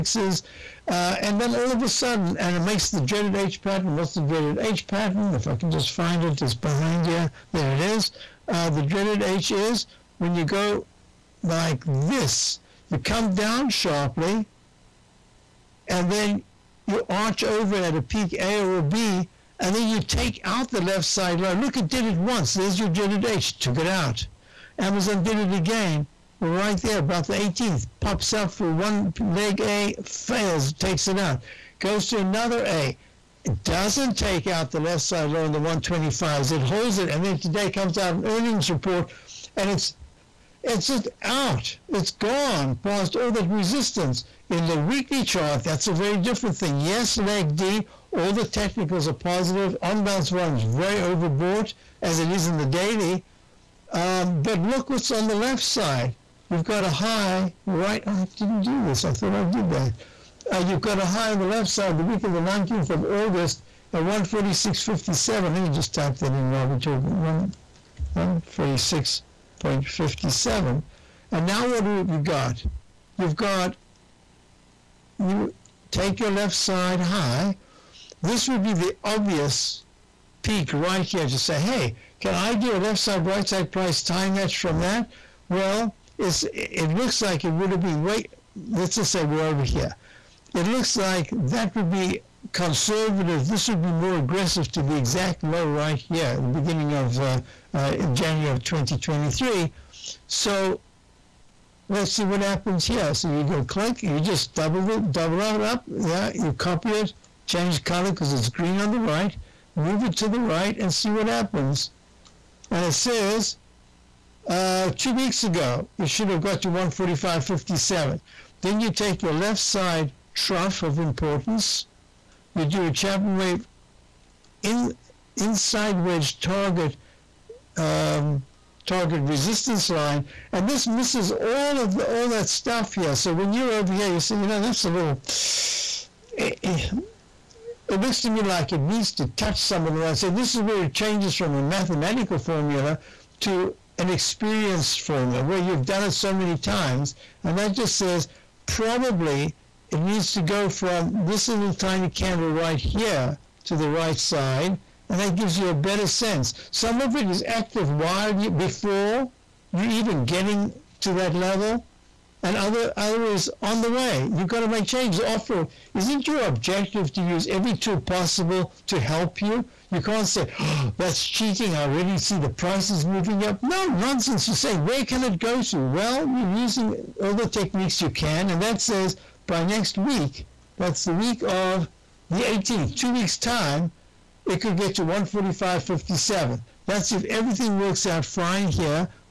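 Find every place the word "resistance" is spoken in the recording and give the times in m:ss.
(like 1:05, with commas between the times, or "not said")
0:43, 2:09.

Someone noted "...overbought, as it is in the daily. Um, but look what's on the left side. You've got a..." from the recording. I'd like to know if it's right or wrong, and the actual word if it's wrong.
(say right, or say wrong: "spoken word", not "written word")
right.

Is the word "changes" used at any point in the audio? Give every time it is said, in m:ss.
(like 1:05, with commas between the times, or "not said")
1:47, 2:20, 2:44.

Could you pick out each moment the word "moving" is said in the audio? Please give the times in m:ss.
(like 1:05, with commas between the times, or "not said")
2:53.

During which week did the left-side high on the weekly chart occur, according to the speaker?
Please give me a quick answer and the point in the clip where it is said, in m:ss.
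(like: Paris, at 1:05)
week of the 19th of August, at 1:01.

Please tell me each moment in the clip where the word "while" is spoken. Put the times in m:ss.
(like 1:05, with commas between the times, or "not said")
1:06, 2:37.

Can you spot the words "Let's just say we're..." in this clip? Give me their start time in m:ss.
1:28.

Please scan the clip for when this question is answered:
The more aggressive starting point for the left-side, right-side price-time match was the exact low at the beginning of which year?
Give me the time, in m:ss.
1:38.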